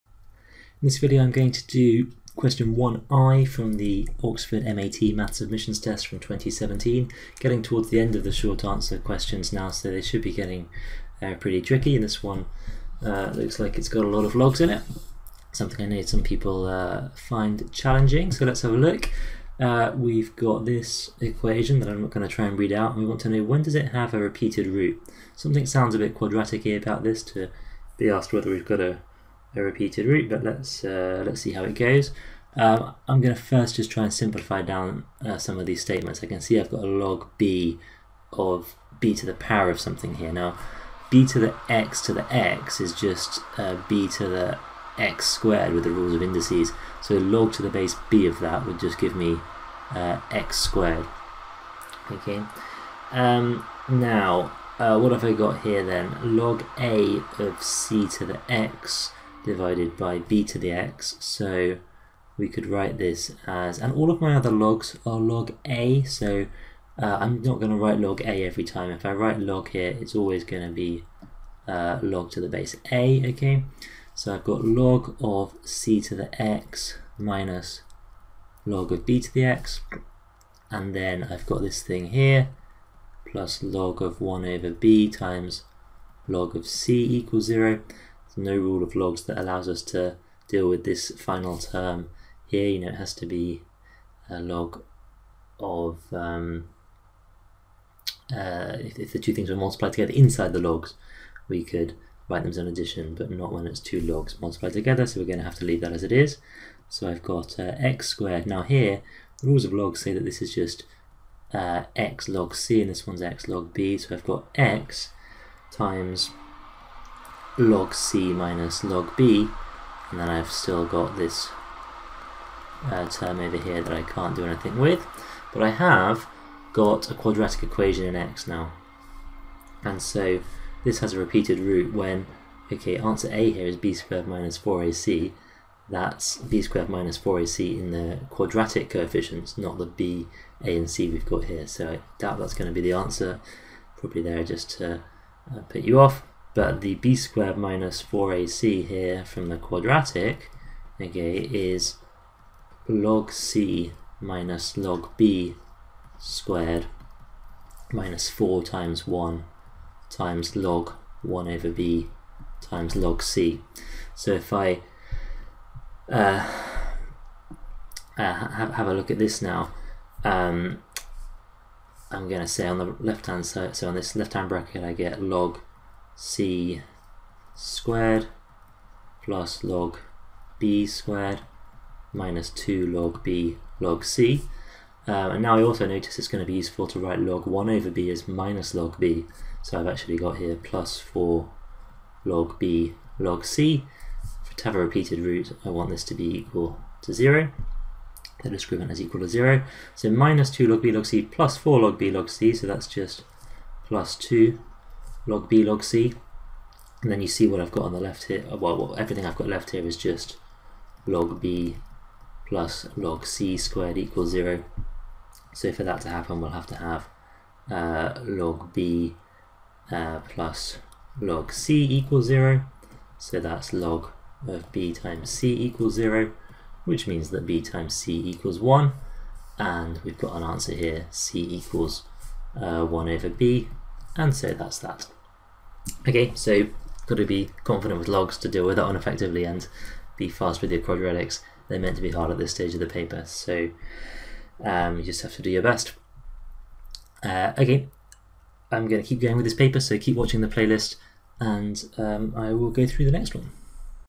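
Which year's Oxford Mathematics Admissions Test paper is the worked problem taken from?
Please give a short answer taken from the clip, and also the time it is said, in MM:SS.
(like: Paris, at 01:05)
2017, at 00:06.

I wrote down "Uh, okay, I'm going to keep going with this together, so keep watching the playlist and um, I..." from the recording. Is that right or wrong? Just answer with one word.
wrong.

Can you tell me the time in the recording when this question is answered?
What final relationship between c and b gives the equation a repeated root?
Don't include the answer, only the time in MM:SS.
03:51.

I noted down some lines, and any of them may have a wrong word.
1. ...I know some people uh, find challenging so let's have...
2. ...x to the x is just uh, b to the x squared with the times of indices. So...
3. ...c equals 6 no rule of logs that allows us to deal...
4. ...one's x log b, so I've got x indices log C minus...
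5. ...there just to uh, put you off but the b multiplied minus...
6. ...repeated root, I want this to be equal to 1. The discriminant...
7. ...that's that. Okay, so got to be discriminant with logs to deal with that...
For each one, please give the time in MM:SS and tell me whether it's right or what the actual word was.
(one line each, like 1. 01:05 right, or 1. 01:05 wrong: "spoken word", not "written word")
1. 00:15 right
2. 00:41 wrong: "rules", not "times"
3. 01:26 wrong: "0", not "6"
4. 01:53 wrong: "times", not "indices"
5. 02:24 wrong: "squared", not "multiplied"
6. 03:14 wrong: "0", not "1"
7. 03:54 wrong: "confident", not "discriminant".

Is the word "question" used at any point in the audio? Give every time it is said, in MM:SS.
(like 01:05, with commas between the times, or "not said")
00:02, 00:08.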